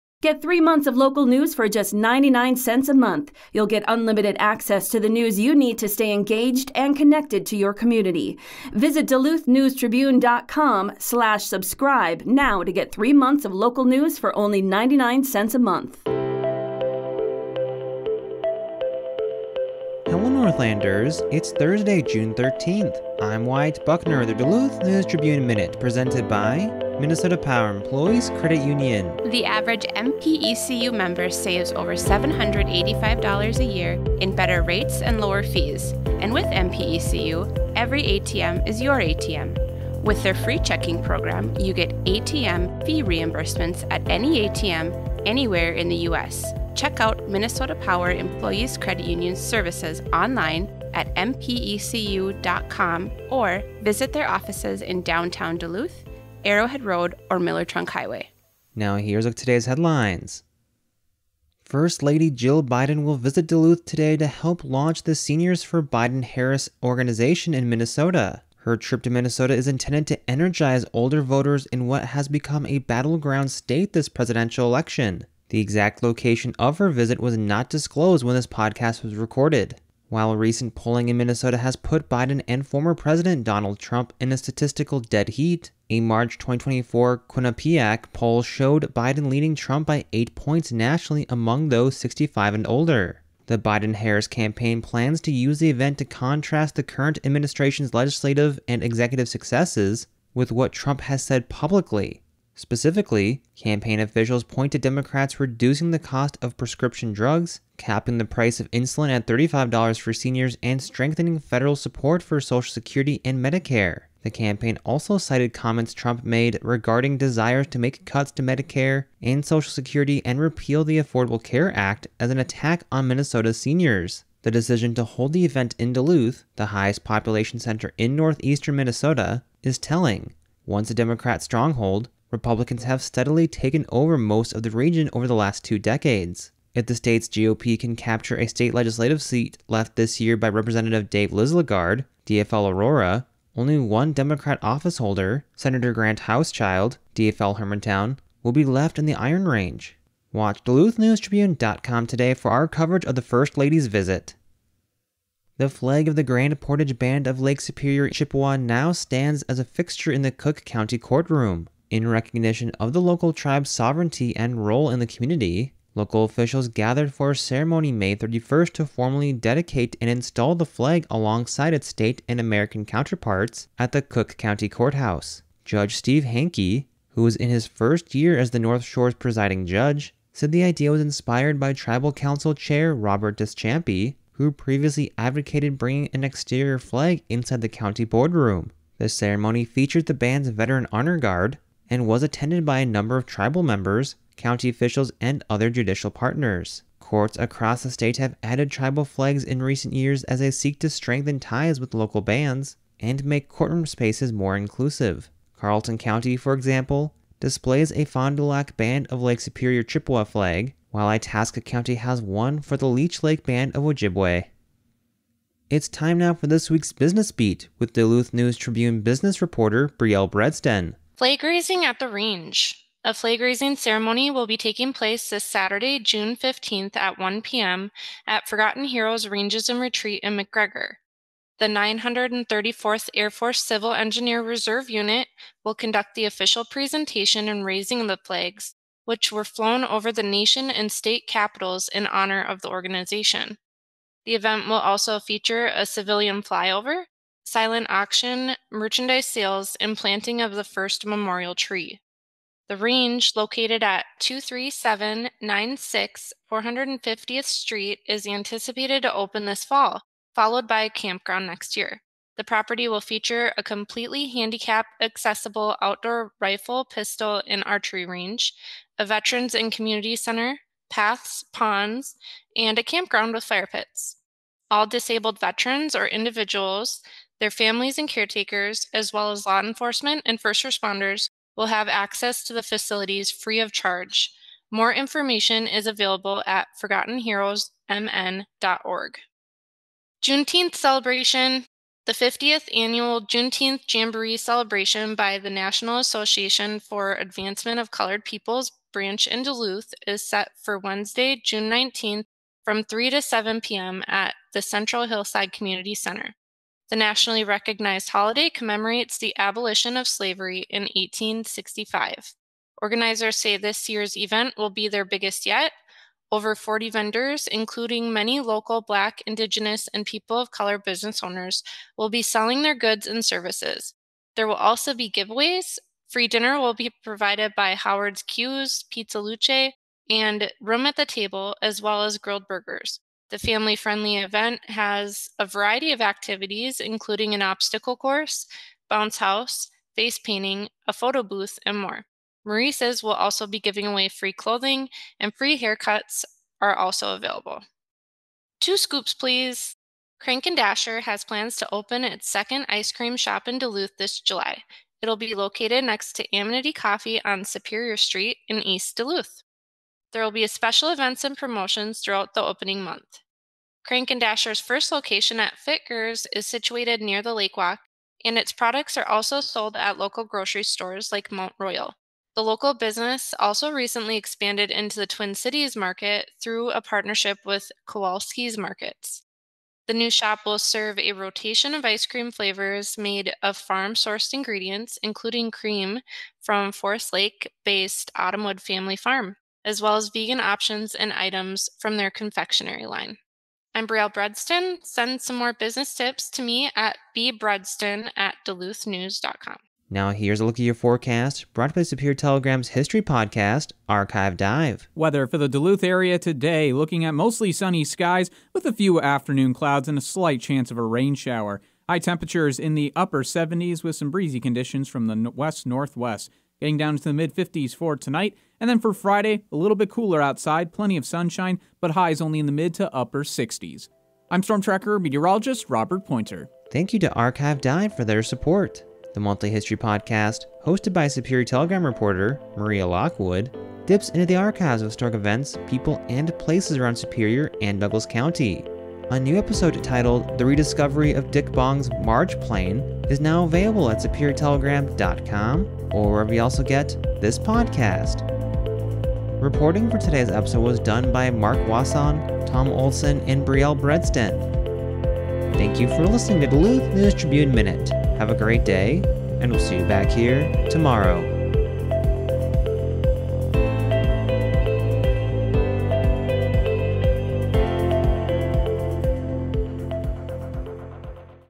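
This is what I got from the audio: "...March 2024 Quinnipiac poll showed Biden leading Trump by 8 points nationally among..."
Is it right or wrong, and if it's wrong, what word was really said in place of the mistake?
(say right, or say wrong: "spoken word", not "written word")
right.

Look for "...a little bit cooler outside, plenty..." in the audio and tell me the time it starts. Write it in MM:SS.
06:59.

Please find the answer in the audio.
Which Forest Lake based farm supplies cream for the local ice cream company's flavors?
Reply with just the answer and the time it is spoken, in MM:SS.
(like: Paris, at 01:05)
Autumnwood Family Farm, at 06:28.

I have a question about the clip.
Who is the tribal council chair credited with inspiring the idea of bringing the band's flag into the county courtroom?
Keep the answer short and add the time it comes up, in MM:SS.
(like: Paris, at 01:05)
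Robert Deschampe, at 03:02.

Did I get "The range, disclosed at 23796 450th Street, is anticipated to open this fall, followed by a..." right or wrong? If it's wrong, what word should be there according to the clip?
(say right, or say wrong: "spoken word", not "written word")
wrong: "located", not "disclosed".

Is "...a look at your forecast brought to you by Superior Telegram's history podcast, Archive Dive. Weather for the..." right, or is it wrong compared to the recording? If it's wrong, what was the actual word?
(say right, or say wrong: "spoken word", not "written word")
right.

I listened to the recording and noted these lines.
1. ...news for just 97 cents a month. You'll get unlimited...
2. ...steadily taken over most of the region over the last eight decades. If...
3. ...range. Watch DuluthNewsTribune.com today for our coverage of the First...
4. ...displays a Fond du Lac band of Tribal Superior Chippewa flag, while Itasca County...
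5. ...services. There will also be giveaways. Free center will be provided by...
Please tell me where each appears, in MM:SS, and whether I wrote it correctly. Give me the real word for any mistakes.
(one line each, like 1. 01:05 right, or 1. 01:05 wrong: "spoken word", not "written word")
1. 00:01 wrong: "99", not "97"
2. 02:13 wrong: "two", not "eight"
3. 02:29 right
4. 03:27 wrong: "Lake", not "Tribal"
5. 05:23 wrong: "dinner", not "center".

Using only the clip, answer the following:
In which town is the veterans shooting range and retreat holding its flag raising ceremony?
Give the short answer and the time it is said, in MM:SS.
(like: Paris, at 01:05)
McGregor, at 03:50.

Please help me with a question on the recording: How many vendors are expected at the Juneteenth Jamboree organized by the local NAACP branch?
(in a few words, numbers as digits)
40.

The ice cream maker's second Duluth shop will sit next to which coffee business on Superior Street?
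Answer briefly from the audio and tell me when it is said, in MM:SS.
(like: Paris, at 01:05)
Amenity Coffee, at 05:56.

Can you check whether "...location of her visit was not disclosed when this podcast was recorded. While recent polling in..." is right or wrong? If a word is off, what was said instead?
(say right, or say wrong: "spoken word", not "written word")
right.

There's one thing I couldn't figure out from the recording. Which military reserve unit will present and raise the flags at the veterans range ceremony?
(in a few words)
934th Air Force Civil Engineer Reserve Unit.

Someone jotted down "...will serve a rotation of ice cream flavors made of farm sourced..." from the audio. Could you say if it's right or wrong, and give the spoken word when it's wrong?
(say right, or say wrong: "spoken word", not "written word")
right.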